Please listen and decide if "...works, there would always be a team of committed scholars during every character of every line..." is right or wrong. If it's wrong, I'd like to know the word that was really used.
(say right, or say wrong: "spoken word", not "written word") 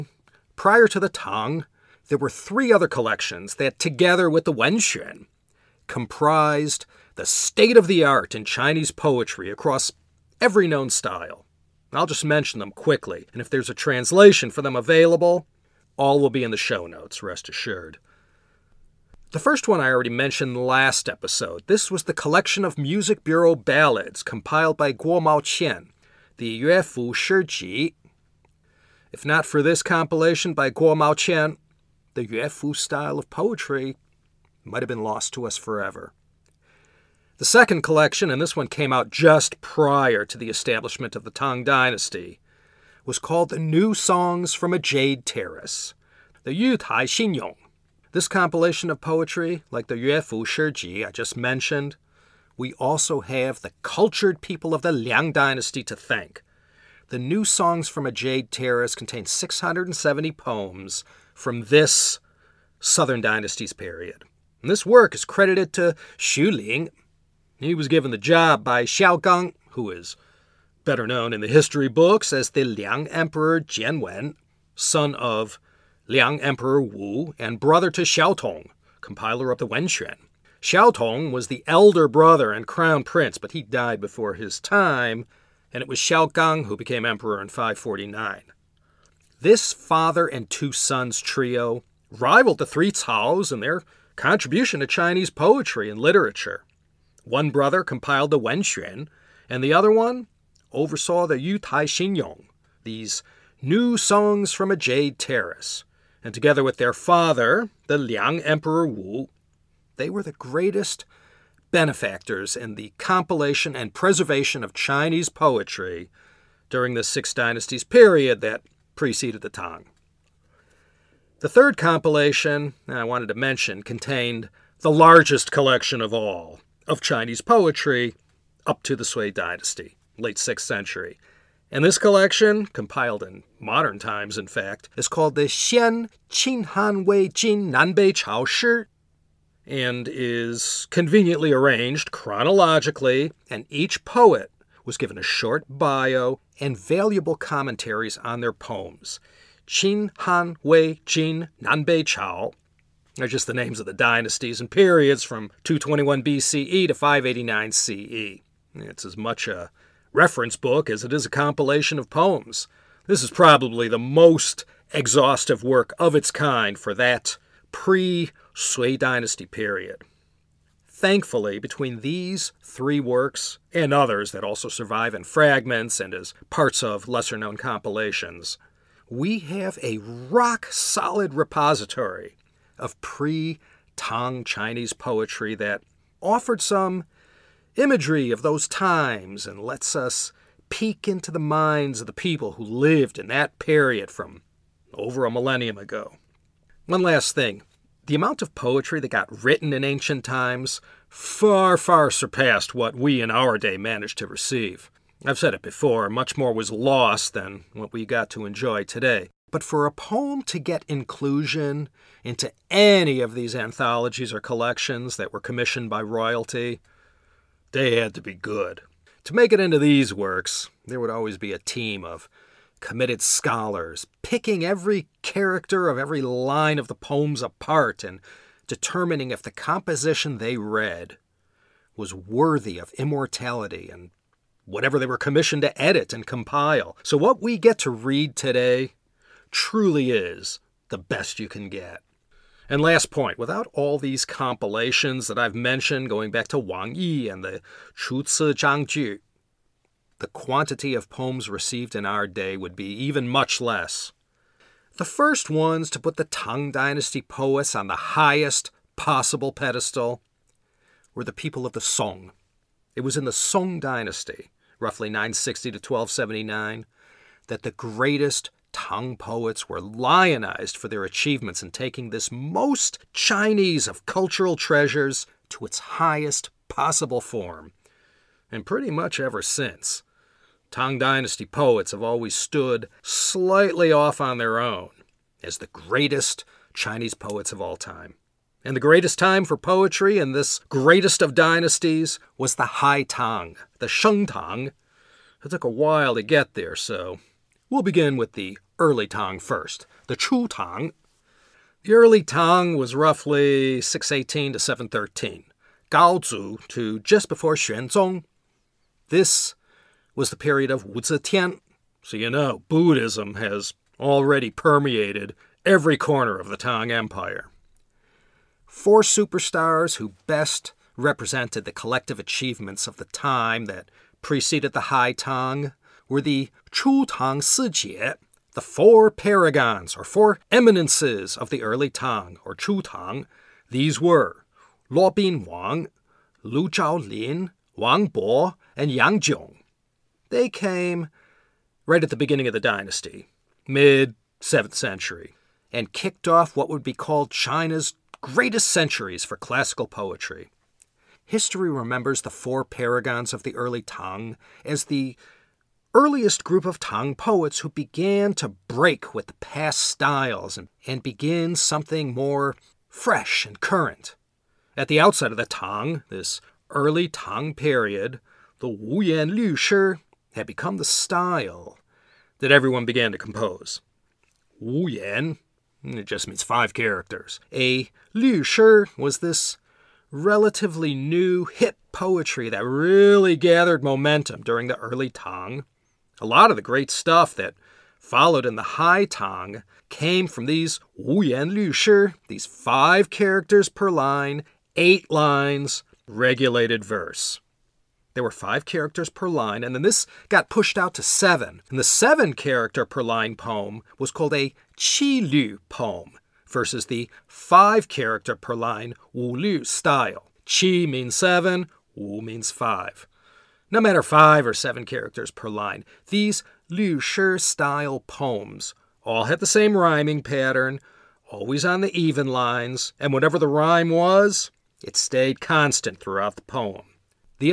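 wrong: "picking", not "during".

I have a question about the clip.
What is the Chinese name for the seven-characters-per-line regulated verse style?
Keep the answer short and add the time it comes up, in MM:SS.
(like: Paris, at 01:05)
Qi Lu, at 06:44.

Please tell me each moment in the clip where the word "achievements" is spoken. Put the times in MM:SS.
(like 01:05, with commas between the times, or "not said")
04:31, 05:22.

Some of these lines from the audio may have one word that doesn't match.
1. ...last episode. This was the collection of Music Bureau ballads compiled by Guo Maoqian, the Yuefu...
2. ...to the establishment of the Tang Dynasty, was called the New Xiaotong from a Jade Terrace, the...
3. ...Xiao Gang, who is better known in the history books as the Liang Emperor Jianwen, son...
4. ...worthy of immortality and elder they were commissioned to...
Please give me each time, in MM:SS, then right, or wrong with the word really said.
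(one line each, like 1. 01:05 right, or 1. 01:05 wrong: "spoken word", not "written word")
1. 00:20 right
2. 00:40 wrong: "Songs", not "Xiaotong"
3. 01:08 right
4. 03:52 wrong: "whatever", not "elder".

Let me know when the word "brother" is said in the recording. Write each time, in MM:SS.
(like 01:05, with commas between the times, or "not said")
01:17, 01:22, 01:37.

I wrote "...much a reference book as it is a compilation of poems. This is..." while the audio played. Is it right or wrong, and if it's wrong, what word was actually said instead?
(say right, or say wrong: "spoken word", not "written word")
right.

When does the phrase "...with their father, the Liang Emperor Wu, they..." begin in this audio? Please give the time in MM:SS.
01:46.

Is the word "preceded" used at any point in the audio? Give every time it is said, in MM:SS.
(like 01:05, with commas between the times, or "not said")
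01:58, 05:24.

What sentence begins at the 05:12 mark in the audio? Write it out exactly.
So you know, Buddhism has already permeated every corner of the Tang Empire.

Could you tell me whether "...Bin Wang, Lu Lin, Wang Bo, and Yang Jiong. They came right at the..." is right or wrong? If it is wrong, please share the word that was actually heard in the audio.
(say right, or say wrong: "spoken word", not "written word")
right.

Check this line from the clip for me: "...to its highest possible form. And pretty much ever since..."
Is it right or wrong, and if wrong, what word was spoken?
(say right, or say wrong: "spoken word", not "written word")
right.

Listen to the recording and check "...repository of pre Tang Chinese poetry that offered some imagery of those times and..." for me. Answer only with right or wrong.
right.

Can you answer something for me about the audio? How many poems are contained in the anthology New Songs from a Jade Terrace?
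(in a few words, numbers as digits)
670.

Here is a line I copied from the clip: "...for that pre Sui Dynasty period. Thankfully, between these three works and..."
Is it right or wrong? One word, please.
right.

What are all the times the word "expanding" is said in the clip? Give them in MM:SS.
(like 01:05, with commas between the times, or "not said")
not said.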